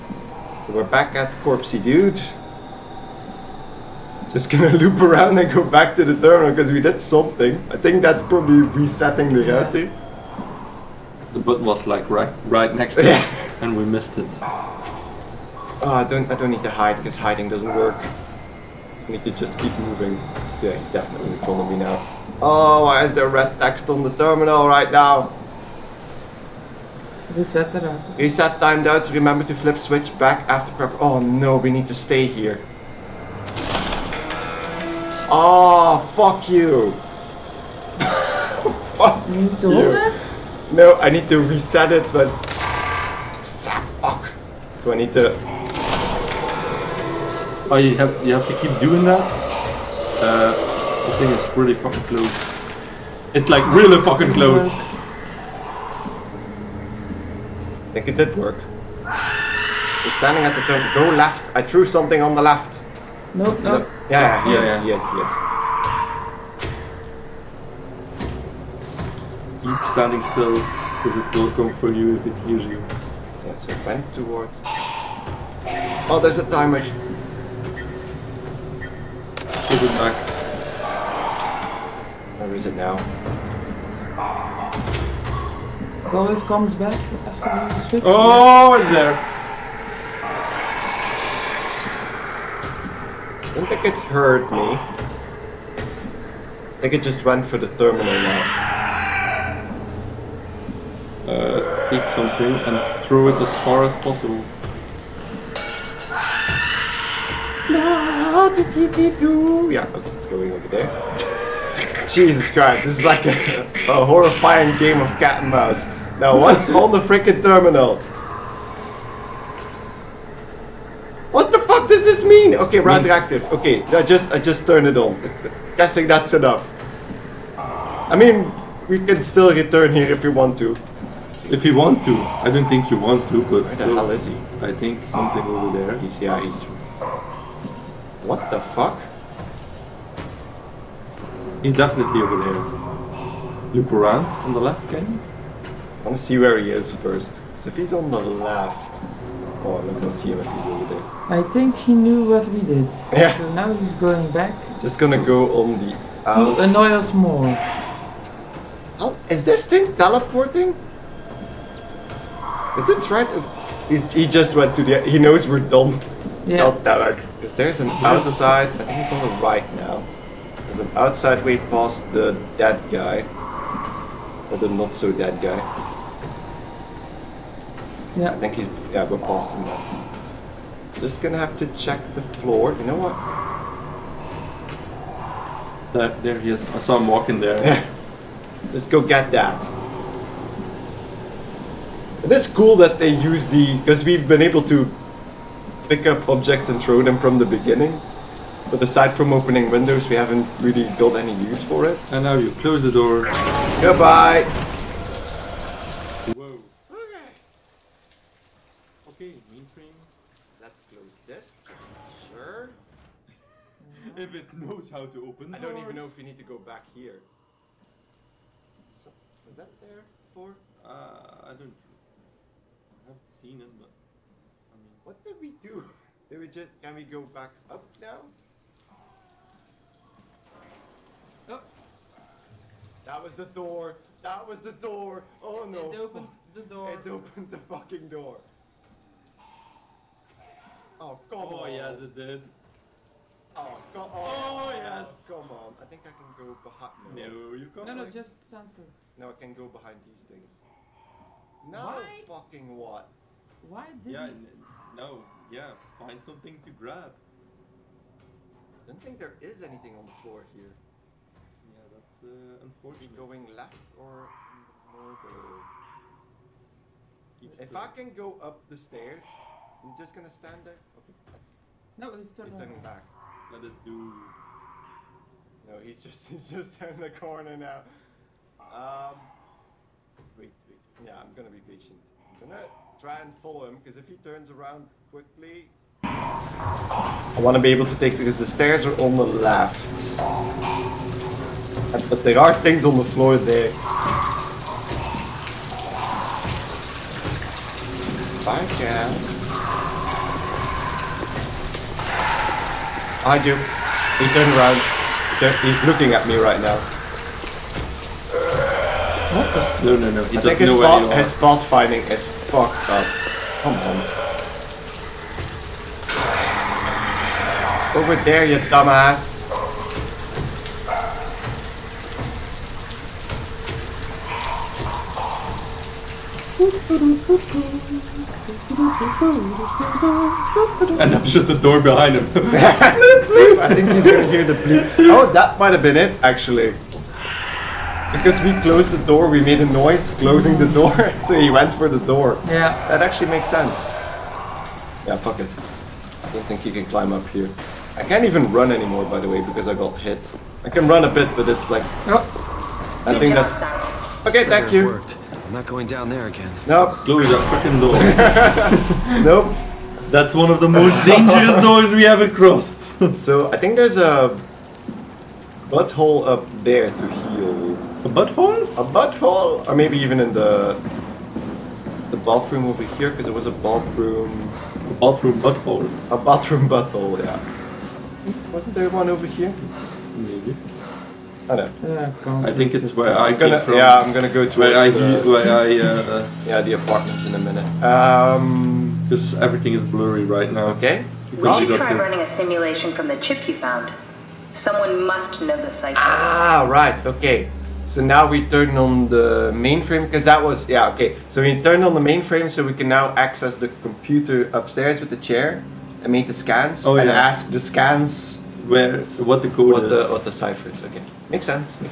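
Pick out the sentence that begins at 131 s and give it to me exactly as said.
If you want to, I don't think you want to, but Where still, the hell is he?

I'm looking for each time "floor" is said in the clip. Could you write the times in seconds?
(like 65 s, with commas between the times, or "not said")
182 s, 260 s, 293 s.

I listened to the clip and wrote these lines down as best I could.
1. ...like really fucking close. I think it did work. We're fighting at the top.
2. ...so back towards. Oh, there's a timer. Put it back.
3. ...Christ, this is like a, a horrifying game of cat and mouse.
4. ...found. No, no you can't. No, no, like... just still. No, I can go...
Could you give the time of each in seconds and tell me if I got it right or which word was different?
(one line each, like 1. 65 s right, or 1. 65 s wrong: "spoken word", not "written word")
1. 53 s wrong: "standing", not "fighting"
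2. 73 s right
3. 112 s right
4. 246 s wrong: "behind", not "found".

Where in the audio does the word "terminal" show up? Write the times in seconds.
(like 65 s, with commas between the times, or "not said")
6 s, 24 s, 97 s, 117 s.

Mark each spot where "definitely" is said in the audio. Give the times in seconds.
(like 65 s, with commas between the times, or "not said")
20 s, 141 s.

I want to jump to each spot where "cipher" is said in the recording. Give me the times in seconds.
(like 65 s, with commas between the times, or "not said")
395 s, 410 s.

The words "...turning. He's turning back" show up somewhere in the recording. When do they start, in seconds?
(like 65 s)
272 s.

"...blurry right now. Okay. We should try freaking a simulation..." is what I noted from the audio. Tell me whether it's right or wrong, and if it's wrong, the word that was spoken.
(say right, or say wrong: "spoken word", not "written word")
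wrong: "running", not "freaking".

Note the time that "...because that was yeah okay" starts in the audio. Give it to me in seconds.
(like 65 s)
400 s.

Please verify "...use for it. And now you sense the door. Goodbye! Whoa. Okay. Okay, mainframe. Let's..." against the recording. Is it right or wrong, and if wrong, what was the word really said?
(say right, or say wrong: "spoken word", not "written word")
wrong: "close", not "sense".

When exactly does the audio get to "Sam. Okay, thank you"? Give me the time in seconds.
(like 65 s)
353 s.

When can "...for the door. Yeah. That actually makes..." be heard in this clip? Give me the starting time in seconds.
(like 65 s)
341 s.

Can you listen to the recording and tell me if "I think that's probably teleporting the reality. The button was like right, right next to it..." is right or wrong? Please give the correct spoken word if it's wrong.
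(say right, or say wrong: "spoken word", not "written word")
wrong: "resetting", not "teleporting".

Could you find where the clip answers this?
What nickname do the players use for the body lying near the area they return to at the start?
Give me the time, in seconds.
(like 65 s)
1 s.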